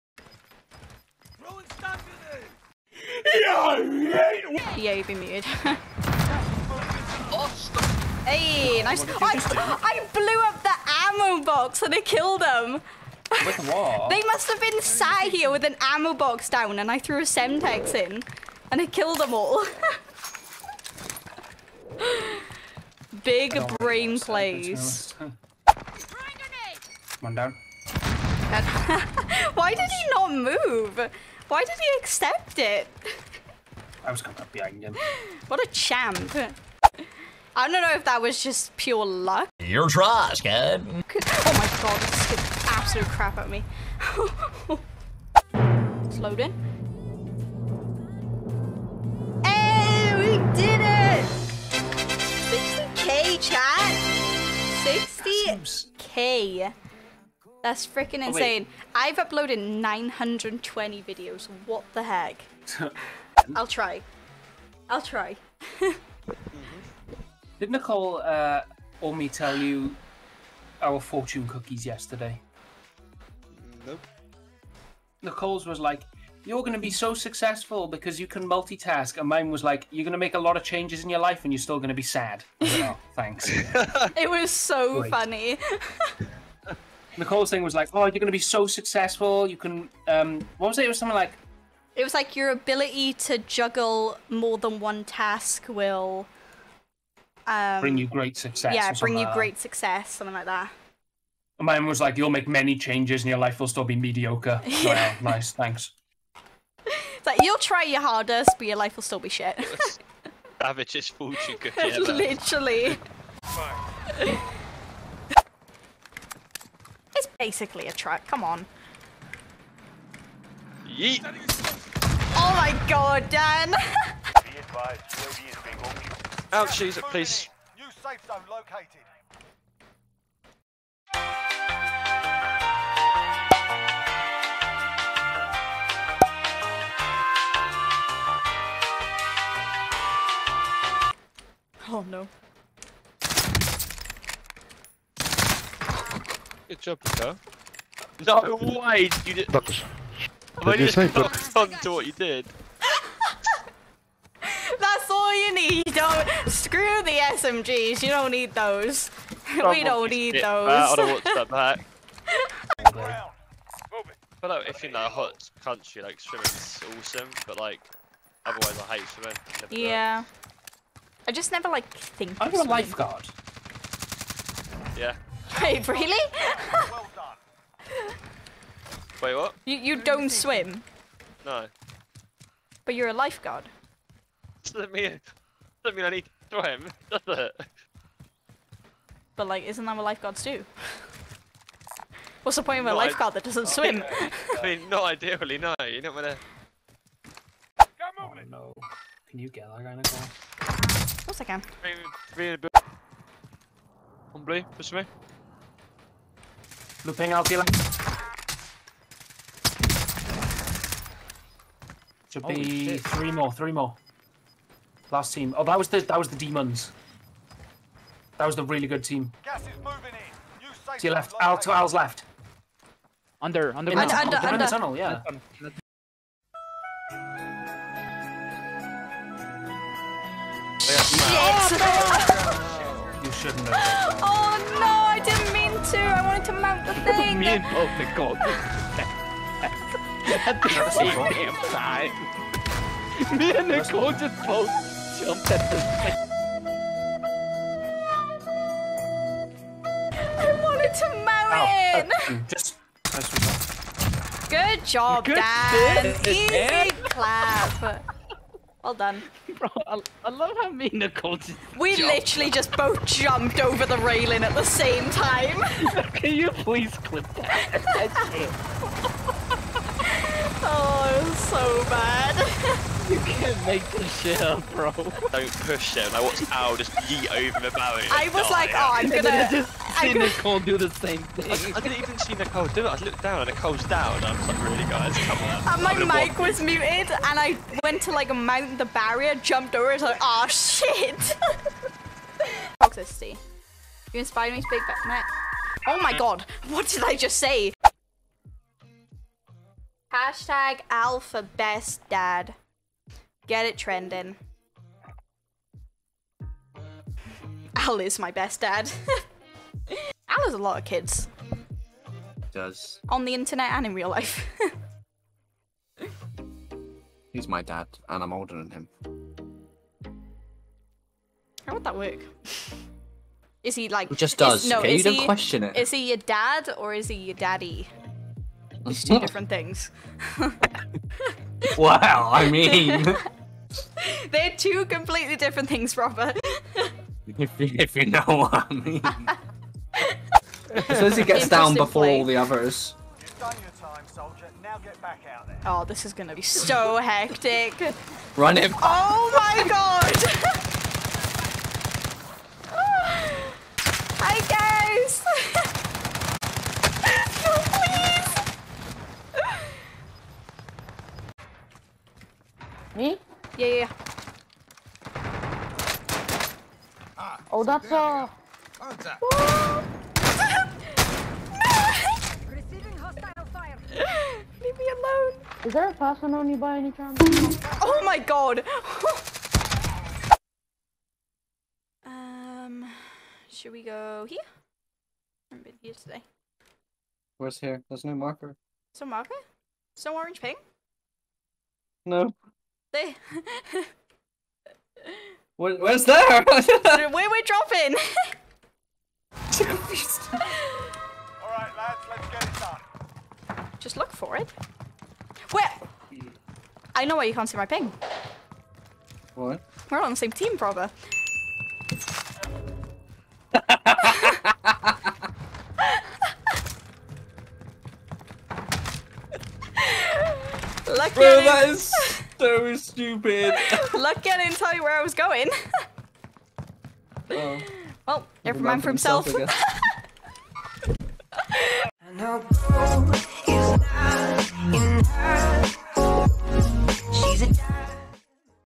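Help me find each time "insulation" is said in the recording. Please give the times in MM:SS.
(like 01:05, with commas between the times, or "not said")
not said.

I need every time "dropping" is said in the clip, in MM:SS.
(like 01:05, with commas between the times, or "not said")
06:37.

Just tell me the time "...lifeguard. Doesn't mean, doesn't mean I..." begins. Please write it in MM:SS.
03:03.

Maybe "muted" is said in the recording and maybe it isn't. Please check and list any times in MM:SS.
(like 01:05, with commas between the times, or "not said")
00:05, 04:46.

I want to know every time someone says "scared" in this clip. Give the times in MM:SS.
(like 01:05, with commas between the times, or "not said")
00:42.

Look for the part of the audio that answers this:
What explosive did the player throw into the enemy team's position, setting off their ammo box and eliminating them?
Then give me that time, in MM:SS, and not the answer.
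00:17.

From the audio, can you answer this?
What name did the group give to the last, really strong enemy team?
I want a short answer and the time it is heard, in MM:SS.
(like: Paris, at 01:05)
the demons, at 03:36.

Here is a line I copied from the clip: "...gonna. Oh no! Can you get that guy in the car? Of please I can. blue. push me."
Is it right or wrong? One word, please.
wrong.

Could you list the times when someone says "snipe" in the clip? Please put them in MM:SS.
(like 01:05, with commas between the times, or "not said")
02:30.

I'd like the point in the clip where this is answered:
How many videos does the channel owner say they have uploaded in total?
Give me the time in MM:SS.
00:59.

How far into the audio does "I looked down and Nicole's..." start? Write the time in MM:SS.
04:42.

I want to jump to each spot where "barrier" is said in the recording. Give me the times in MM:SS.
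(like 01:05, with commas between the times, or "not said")
04:37, 04:48.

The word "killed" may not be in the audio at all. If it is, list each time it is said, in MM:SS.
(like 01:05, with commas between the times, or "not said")
00:12, 00:18.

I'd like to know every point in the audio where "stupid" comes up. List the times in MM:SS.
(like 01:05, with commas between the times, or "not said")
07:02.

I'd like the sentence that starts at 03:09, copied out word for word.
But like, isn't that what lifeguards do?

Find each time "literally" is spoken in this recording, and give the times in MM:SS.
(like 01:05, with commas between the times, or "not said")
01:52, 04:22.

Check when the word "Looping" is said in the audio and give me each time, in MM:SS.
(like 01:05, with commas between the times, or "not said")
03:27.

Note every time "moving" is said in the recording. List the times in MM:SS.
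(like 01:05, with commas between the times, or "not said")
03:39.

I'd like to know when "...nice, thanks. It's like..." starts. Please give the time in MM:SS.
01:45.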